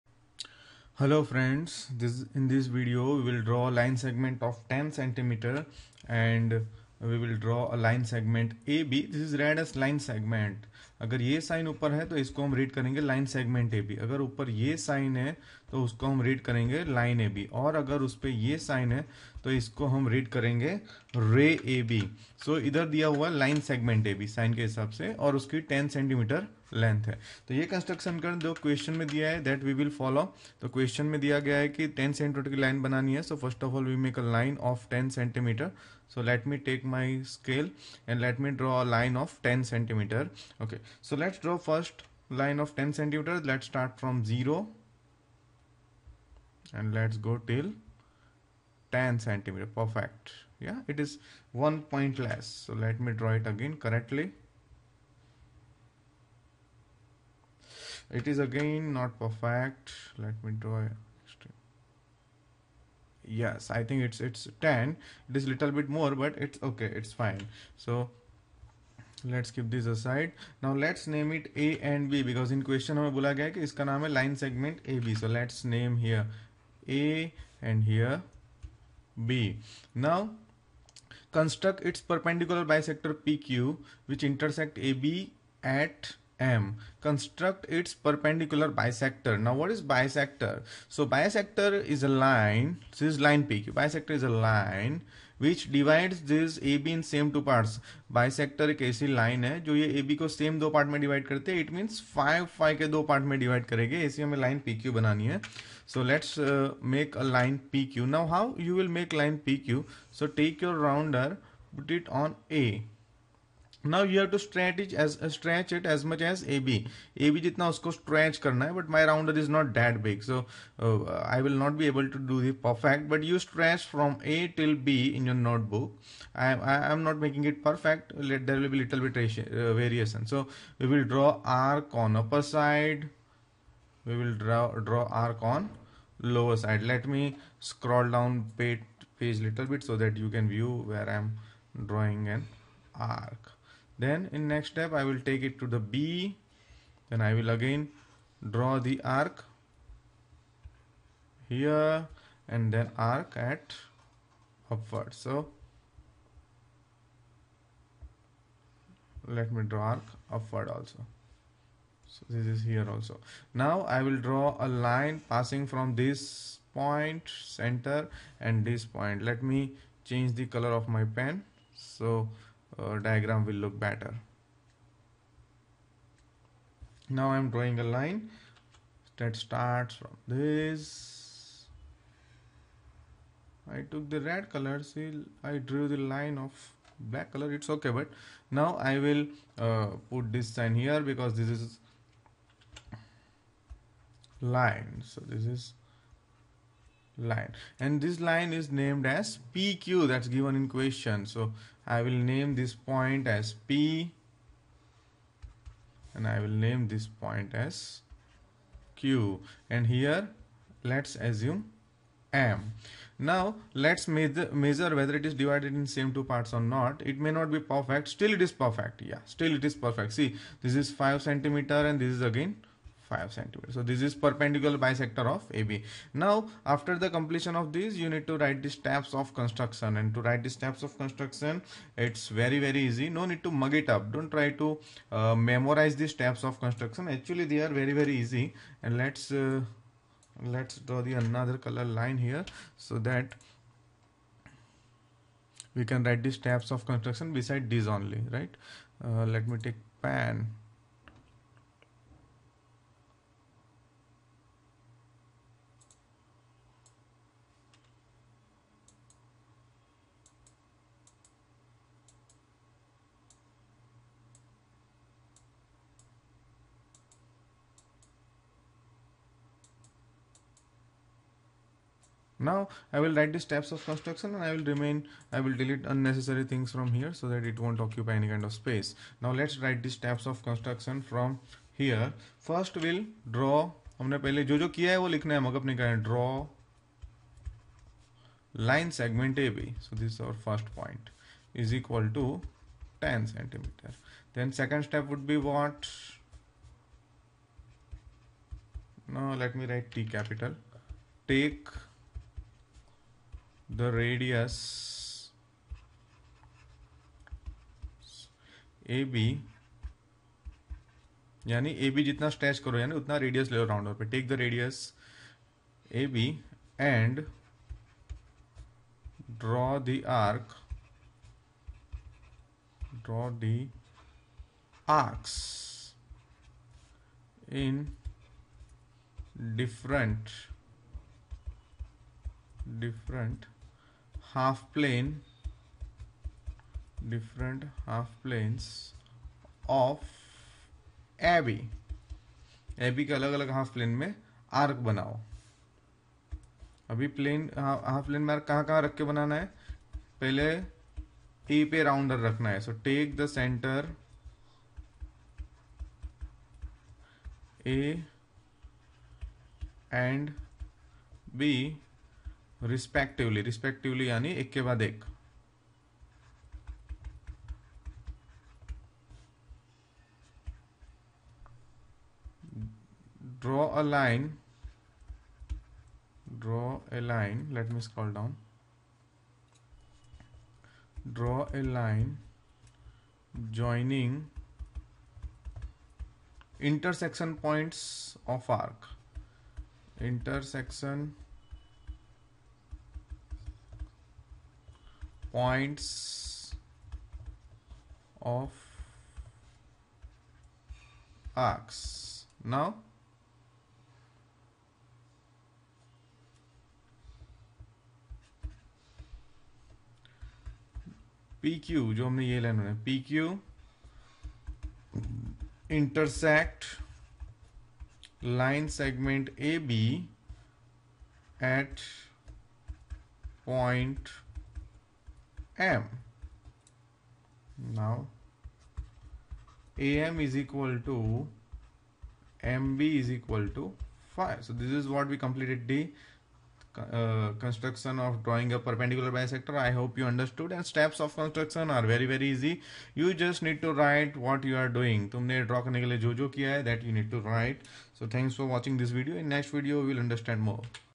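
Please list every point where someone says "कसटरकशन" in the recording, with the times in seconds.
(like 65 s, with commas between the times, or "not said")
27 s.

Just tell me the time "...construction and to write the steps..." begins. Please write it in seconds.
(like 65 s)
229 s.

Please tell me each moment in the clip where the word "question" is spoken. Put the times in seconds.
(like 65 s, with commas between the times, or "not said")
72 s, 200 s.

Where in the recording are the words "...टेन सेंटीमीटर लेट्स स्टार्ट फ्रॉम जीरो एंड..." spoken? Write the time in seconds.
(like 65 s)
42 s.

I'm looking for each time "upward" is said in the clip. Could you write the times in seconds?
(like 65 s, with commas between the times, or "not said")
154 s, 160 s.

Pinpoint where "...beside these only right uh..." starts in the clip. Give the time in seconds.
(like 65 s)
247 s.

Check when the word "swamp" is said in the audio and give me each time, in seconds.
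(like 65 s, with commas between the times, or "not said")
not said.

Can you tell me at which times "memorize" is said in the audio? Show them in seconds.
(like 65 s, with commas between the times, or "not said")
235 s.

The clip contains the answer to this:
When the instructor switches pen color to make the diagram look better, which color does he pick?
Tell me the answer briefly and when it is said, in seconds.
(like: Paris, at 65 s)
Red, at 184 s.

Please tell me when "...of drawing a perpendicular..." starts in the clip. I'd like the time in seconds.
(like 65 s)
437 s.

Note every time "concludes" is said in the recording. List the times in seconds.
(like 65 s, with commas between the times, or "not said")
not said.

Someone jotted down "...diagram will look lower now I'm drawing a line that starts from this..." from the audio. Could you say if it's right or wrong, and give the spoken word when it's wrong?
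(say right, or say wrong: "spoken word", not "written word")
wrong: "better", not "lower".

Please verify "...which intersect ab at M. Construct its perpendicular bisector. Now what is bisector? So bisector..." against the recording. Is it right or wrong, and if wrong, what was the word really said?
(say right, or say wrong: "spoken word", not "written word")
right.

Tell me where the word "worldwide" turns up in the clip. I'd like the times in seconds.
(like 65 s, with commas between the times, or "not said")
not said.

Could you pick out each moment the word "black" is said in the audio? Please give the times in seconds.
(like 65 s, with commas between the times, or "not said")
186 s.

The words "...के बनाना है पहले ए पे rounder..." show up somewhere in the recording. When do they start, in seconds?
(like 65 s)
348 s.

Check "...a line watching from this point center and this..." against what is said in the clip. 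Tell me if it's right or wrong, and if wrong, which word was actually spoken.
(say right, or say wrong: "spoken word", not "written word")
wrong: "passing", not "watching".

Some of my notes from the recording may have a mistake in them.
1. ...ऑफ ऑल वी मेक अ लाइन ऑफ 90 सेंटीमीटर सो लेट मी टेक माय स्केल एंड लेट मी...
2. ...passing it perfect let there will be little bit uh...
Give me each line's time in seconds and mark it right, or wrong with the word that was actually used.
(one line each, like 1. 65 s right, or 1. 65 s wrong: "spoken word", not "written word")
1. 33 s wrong: "10", not "90"
2. 127 s wrong: "making", not "passing".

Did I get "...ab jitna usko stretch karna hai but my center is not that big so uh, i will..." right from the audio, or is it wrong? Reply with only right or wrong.
wrong.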